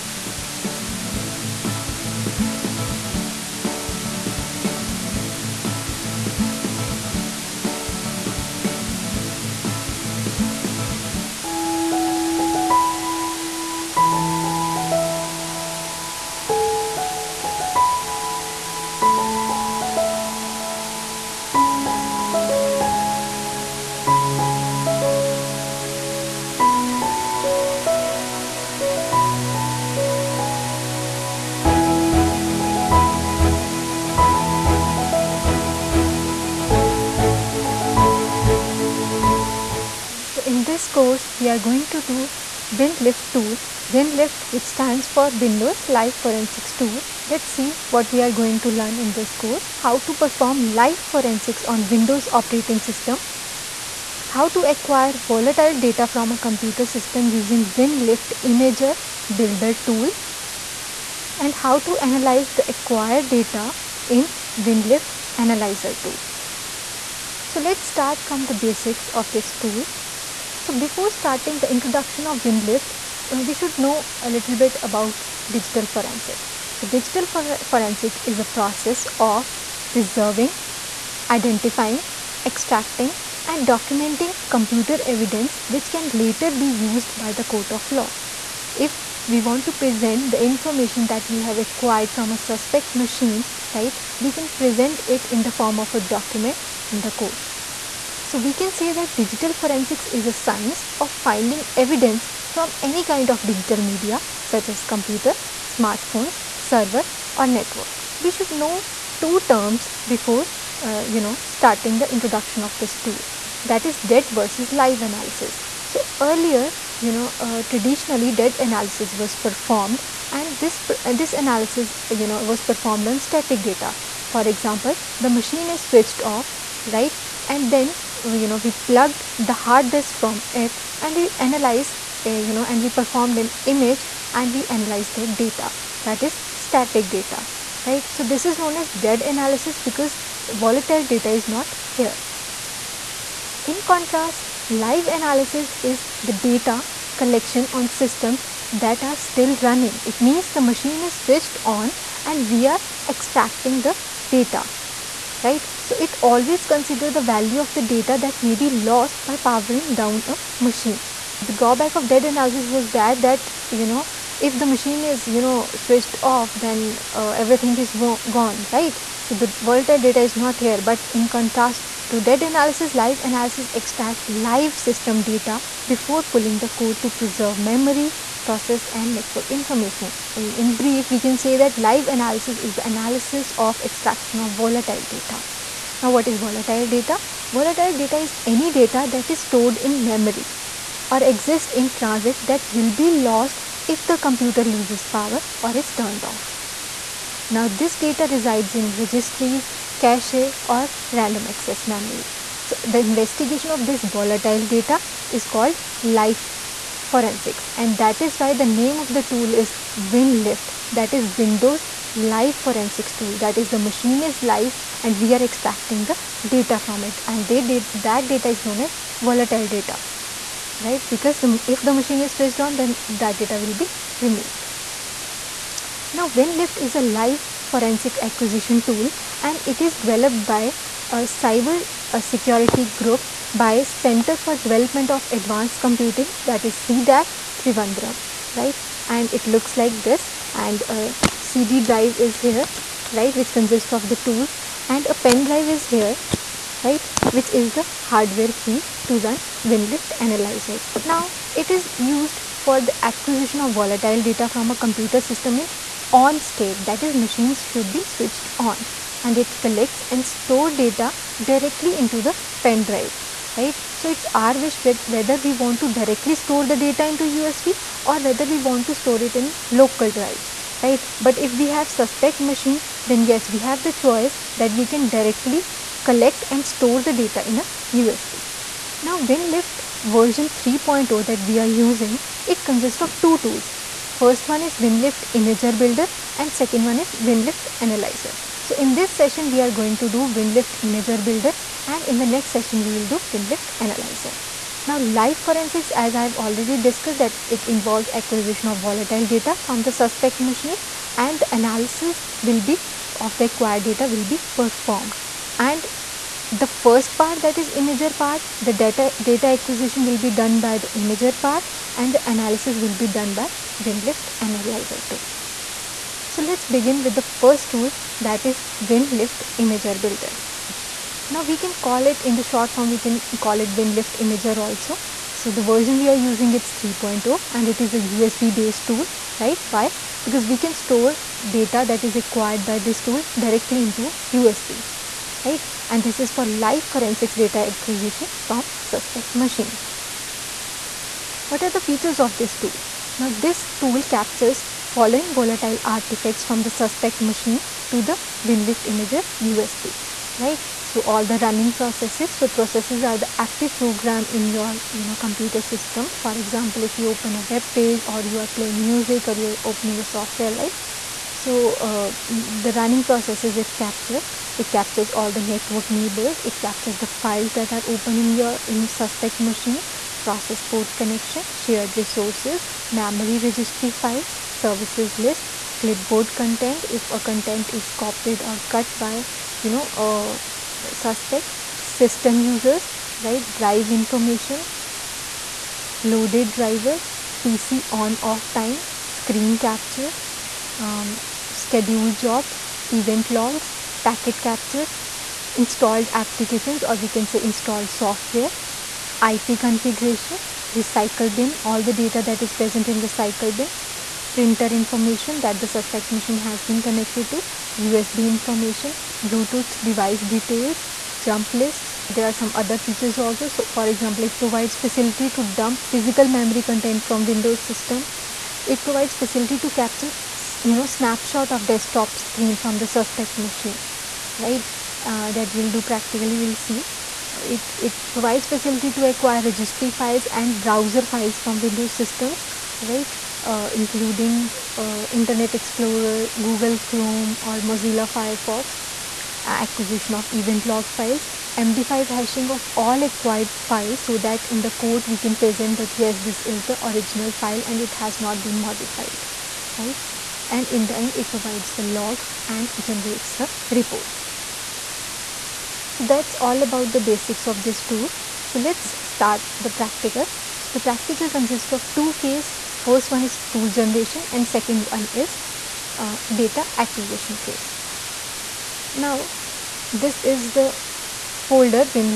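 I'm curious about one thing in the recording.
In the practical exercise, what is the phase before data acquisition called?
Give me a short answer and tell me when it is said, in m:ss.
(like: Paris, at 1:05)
tool generation, at 7:43.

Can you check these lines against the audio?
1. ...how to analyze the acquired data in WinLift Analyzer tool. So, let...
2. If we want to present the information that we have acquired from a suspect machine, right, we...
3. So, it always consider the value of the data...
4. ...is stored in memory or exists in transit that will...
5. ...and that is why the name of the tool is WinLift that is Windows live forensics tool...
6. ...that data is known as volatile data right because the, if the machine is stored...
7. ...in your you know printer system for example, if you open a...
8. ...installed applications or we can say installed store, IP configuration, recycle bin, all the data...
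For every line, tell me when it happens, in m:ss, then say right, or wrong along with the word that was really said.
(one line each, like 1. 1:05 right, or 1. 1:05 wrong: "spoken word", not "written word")
1. 1:01 right
2. 1:28 right
3. 2:35 right
4. 3:09 right
5. 3:27 right
6. 3:38 wrong: "switched", not "stored"
7. 5:54 wrong: "computer", not "printer"
8. 6:35 wrong: "software", not "store".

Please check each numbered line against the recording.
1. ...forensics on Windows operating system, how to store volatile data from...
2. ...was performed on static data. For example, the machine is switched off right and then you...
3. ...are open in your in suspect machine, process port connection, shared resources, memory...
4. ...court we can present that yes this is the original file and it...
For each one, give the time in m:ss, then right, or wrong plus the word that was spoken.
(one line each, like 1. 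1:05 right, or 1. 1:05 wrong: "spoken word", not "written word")
1. 0:50 wrong: "acquire", not "store"
2. 2:02 right
3. 6:07 right
4. 7:24 right.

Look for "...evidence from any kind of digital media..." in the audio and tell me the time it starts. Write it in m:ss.
1:41.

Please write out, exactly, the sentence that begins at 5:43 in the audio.
Now this tool captures following volatile artifacts from the suspect machine to the WinLift imager USB right.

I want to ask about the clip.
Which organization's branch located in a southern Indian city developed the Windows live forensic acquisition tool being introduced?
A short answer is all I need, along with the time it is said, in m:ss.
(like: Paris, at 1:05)
CDAC Trivandrum, at 3:56.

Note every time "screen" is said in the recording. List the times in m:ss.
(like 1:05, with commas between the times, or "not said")
6:29, 7:02.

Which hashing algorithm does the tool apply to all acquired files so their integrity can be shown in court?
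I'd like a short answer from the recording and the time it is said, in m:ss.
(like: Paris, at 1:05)
MD5, at 7:21.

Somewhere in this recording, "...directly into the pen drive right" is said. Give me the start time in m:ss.
4:21.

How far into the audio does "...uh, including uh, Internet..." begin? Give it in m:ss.
7:13.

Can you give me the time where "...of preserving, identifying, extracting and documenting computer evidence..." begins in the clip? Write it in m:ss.
1:19.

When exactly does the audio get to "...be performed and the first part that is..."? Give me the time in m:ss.
5:04.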